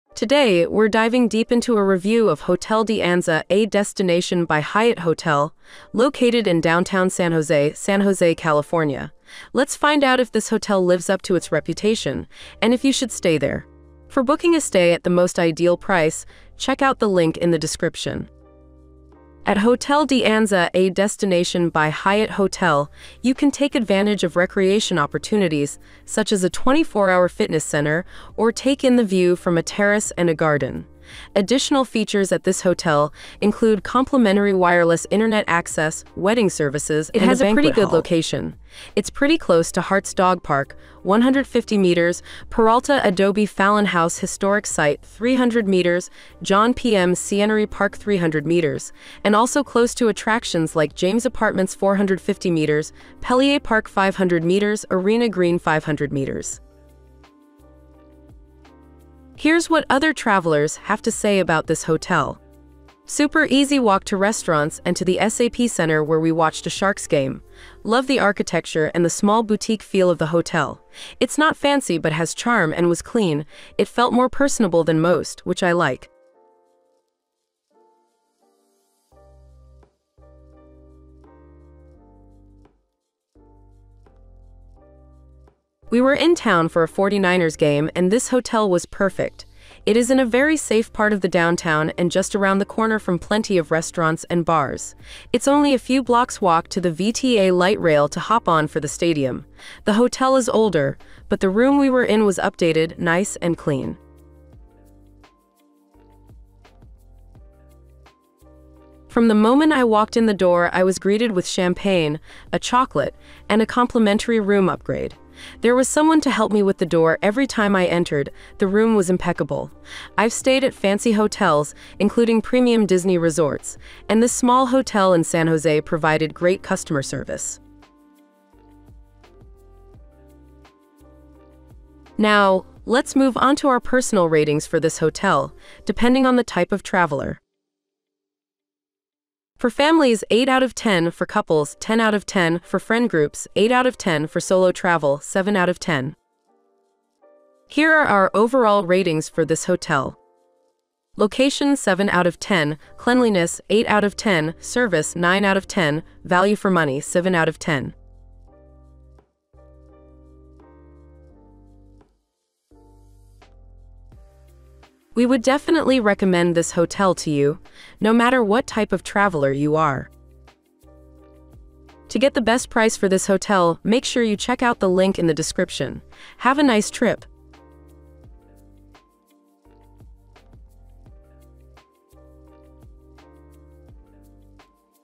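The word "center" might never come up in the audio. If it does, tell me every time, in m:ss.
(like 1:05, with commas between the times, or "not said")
0:27, 1:05.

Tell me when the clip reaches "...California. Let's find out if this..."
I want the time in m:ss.
0:08.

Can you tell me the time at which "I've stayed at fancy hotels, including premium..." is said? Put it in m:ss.
2:00.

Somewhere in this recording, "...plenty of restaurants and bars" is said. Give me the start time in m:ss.
1:33.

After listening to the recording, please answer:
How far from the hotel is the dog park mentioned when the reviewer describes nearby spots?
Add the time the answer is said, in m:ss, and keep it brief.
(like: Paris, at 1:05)
150 meters, at 0:41.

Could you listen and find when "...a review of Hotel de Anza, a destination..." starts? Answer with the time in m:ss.
0:01.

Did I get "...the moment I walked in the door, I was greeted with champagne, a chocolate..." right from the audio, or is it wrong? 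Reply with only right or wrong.
right.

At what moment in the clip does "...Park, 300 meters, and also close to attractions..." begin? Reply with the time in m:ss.
0:47.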